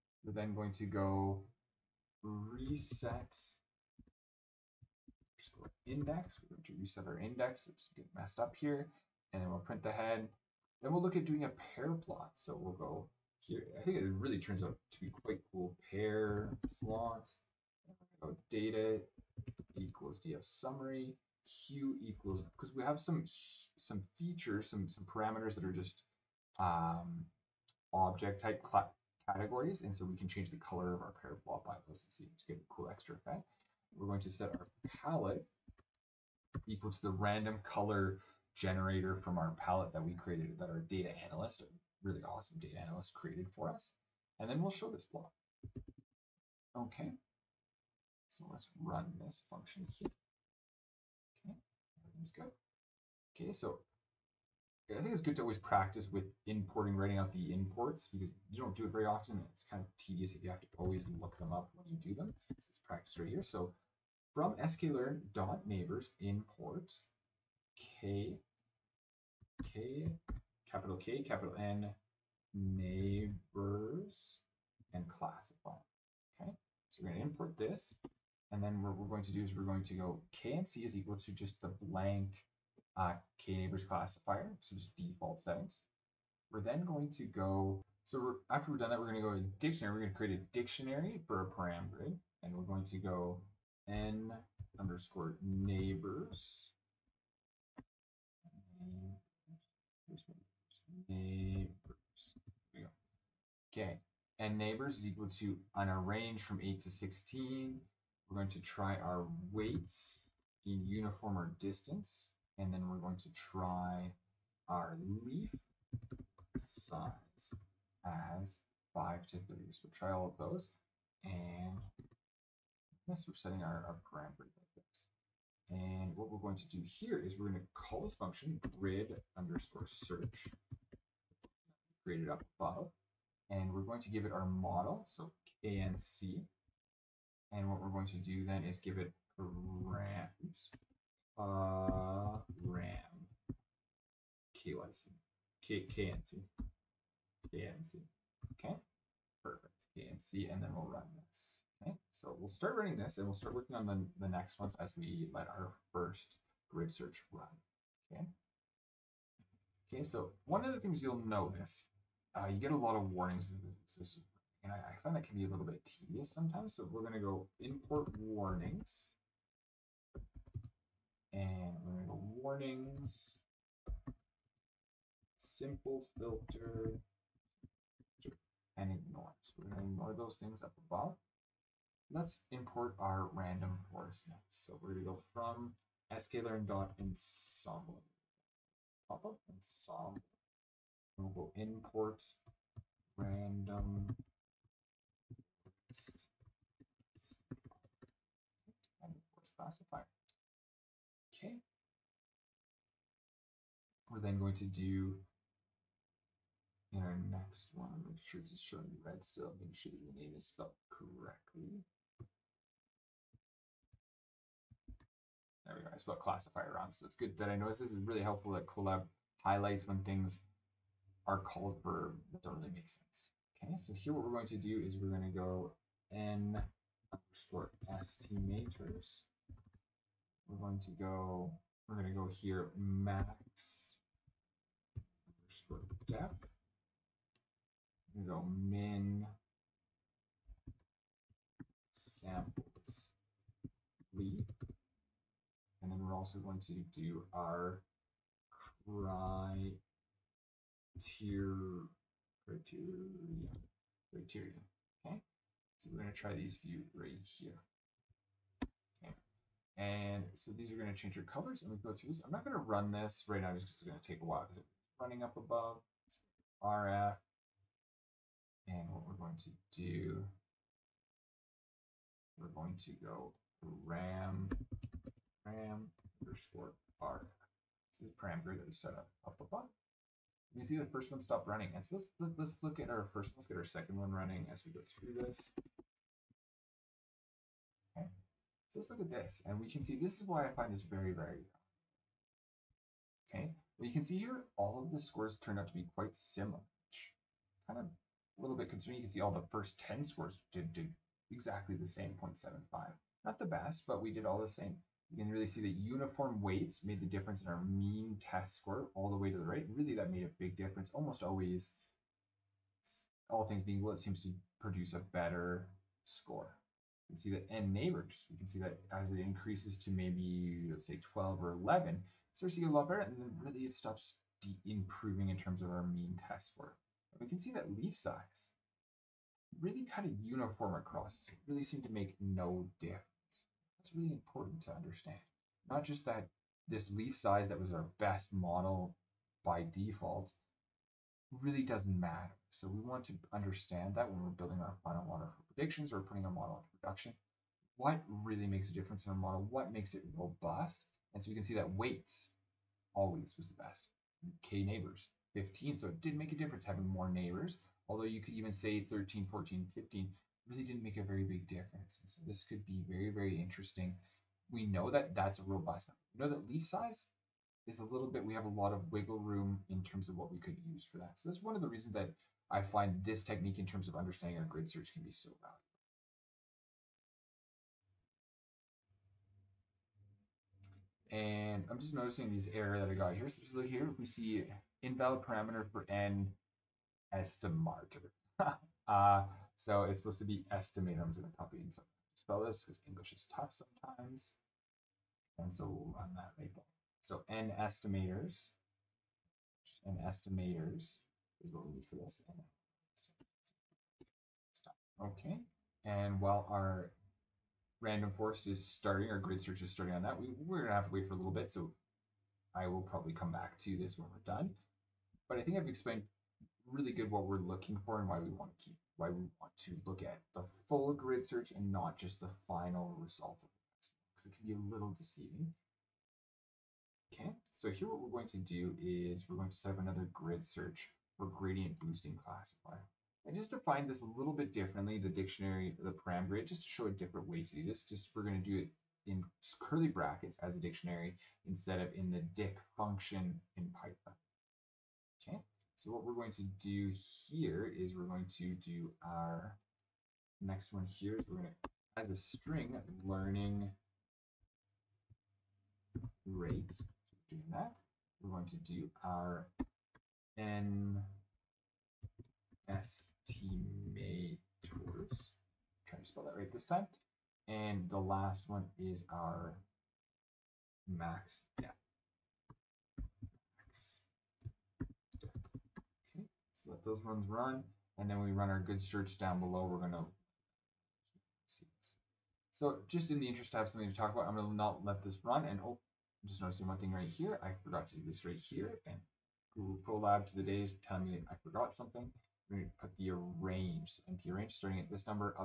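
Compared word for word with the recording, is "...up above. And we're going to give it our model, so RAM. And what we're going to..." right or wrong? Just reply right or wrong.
wrong.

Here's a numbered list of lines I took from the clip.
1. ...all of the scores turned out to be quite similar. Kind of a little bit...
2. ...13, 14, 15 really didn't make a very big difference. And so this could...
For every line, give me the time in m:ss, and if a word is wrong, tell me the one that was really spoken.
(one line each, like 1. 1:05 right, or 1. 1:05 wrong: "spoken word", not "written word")
1. 4:54 right
2. 5:58 right.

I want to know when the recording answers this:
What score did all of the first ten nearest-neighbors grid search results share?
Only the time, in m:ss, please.
5:02.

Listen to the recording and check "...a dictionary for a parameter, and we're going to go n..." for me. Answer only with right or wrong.
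right.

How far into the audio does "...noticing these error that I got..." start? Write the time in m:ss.
6:21.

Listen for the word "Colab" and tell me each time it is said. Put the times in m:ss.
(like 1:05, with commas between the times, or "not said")
3:38, 8:09.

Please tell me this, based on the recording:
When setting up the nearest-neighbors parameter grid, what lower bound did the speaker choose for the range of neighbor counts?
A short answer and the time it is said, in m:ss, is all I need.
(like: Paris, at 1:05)
8, at 1:46.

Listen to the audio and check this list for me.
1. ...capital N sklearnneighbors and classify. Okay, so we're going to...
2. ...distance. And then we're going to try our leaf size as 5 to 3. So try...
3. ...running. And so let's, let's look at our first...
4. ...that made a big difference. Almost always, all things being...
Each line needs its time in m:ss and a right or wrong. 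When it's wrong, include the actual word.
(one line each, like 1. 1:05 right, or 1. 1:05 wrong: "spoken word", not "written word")
1. 1:11 wrong: "neighbors", not "sklearnneighbors"
2. 1:51 right
3. 4:41 right
4. 5:09 right.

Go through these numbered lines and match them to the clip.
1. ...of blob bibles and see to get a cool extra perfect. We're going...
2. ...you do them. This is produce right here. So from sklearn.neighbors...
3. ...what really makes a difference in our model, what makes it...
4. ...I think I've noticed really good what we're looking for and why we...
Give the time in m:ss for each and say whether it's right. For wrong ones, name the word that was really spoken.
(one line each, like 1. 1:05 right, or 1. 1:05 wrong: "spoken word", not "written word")
1. 0:31 wrong: "effect", not "perfect"
2. 1:01 wrong: "practice", not "produce"
3. 5:47 right
4. 6:55 wrong: "explained", not "noticed".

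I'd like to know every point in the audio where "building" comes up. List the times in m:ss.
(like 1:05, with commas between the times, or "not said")
5:44.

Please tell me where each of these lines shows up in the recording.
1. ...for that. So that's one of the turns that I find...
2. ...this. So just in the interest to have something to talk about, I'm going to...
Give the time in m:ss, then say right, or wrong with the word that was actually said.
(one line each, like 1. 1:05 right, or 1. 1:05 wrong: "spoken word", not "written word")
1. 6:10 wrong: "reasons", not "turns"
2. 8:01 right.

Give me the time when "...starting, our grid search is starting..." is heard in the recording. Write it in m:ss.
6:48.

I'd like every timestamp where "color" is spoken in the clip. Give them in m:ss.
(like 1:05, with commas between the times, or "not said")
0:30, 0:37, 4:21.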